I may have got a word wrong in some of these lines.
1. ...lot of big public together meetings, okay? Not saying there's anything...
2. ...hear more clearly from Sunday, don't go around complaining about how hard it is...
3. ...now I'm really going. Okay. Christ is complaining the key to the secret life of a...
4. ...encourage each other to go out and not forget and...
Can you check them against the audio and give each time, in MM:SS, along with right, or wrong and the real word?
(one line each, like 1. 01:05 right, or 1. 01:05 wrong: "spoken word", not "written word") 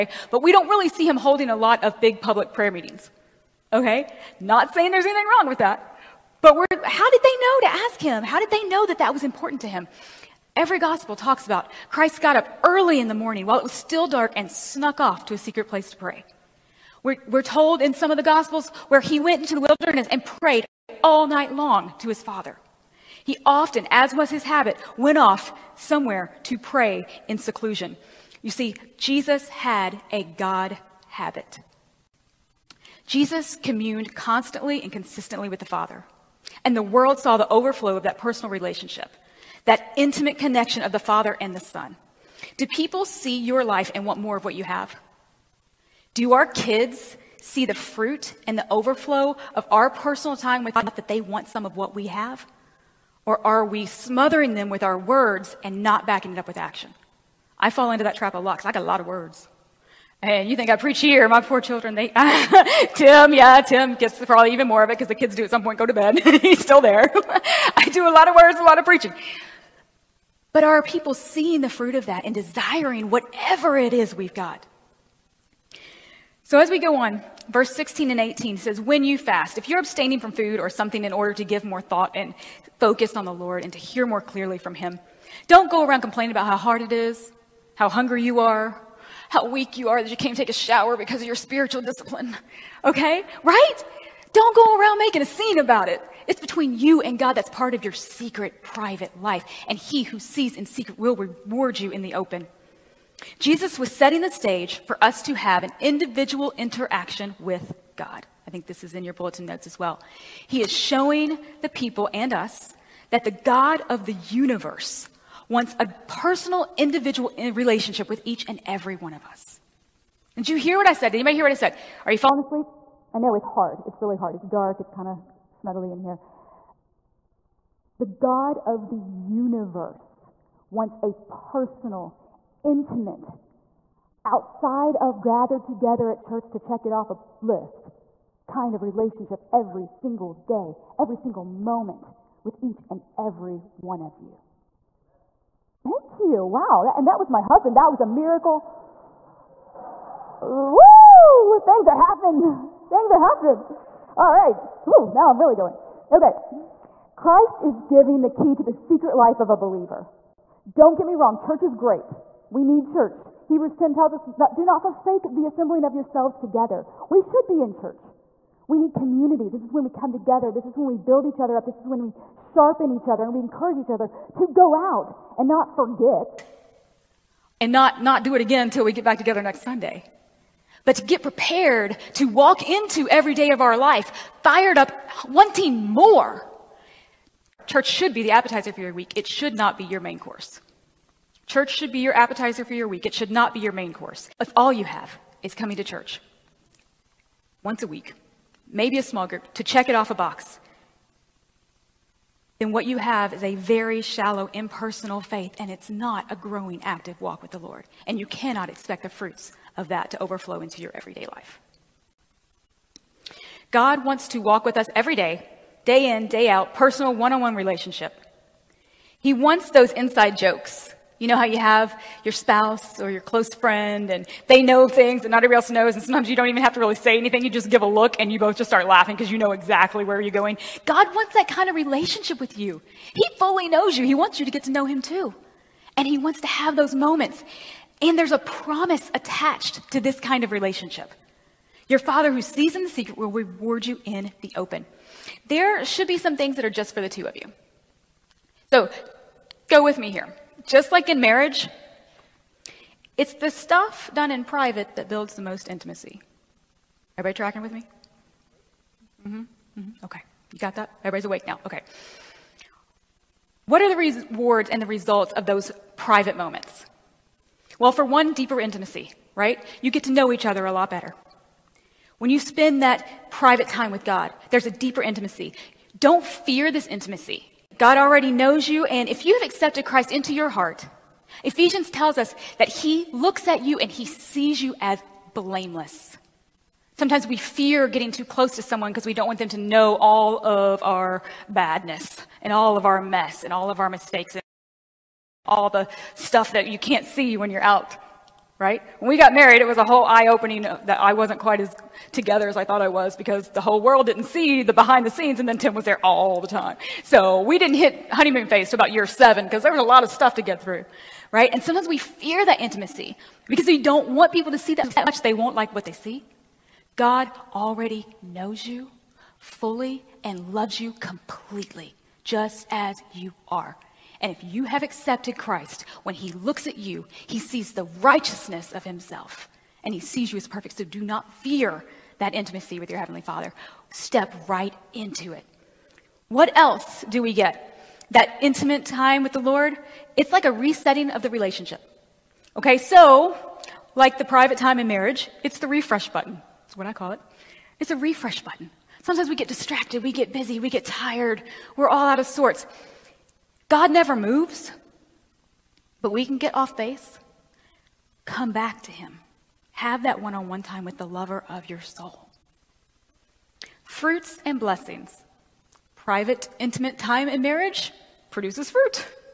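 1. 00:01 wrong: "prayer", not "together"
2. 01:23 wrong: "Him", not "Sunday"
3. 02:35 wrong: "giving", not "complaining"
4. 02:53 right.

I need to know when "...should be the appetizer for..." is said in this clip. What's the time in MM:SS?
03:07.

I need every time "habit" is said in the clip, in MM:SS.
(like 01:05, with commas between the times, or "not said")
00:24, 00:31.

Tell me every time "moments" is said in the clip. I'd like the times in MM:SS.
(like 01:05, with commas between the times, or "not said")
02:21, 03:56, 04:26.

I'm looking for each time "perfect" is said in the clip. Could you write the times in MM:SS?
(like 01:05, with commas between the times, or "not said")
05:30.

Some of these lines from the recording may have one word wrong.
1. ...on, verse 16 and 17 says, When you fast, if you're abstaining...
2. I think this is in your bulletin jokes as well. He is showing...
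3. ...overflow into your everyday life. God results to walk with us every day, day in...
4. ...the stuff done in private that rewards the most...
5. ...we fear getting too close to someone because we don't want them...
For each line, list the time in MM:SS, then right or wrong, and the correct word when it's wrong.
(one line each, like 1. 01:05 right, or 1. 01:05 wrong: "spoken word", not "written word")
1. 01:16 wrong: "18", not "17"
2. 01:48 wrong: "notes", not "jokes"
3. 03:30 wrong: "wants", not "results"
4. 04:13 wrong: "builds", not "rewards"
5. 04:47 right.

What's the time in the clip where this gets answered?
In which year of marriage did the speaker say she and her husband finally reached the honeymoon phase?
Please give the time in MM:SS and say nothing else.
05:08.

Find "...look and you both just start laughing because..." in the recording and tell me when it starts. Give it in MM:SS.
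03:47.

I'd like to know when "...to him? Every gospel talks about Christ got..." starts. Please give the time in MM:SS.
00:09.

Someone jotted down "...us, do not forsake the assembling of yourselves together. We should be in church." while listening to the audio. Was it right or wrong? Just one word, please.
right.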